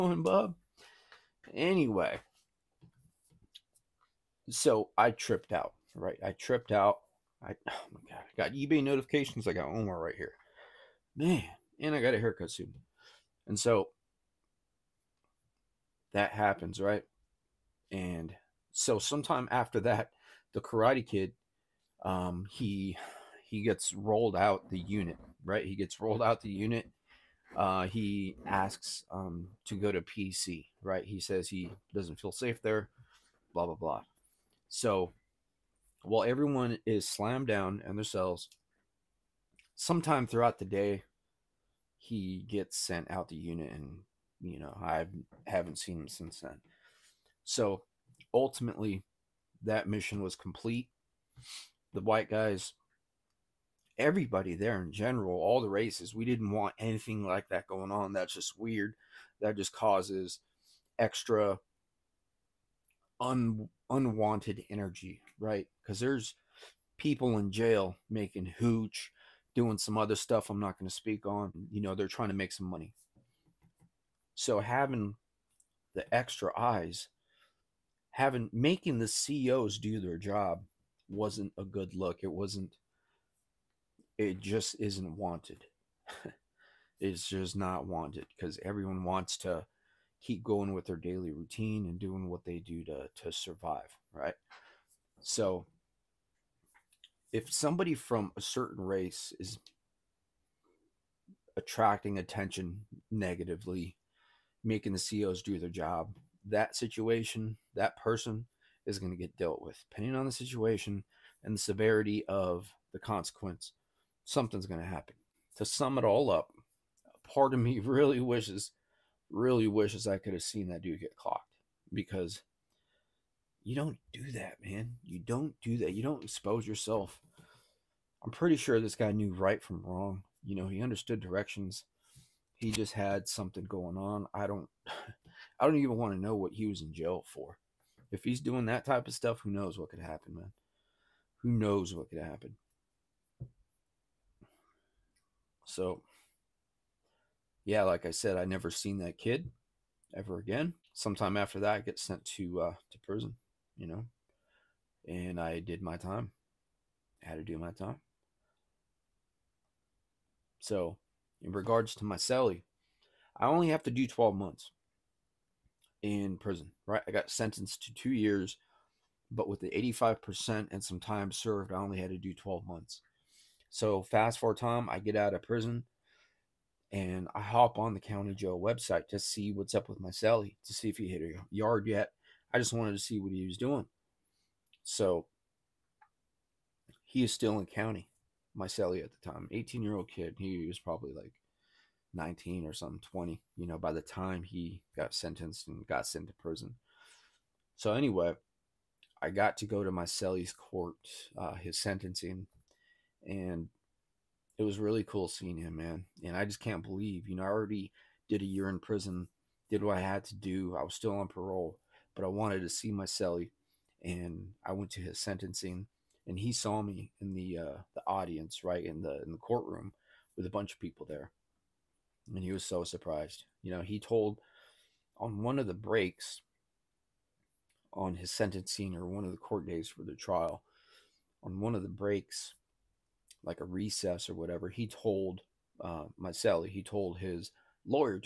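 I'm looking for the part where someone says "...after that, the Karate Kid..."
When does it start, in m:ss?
0:19.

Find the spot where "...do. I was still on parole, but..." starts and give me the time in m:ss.
3:30.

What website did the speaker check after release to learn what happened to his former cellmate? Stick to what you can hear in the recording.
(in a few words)
County Joe.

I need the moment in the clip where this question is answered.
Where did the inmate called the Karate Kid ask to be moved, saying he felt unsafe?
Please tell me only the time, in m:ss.
0:30.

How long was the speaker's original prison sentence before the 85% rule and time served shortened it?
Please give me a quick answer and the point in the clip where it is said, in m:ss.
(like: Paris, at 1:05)
2 years, at 2:47.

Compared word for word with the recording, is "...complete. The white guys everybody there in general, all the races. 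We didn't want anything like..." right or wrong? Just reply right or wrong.
right.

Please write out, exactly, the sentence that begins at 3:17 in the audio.
So anyway, I got to go to my celly's court, uh, his sentencing and it was really cool seeing him, man.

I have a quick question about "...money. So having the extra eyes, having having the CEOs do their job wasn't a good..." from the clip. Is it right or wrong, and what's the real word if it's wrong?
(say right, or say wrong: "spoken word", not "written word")
wrong: "making", not "having".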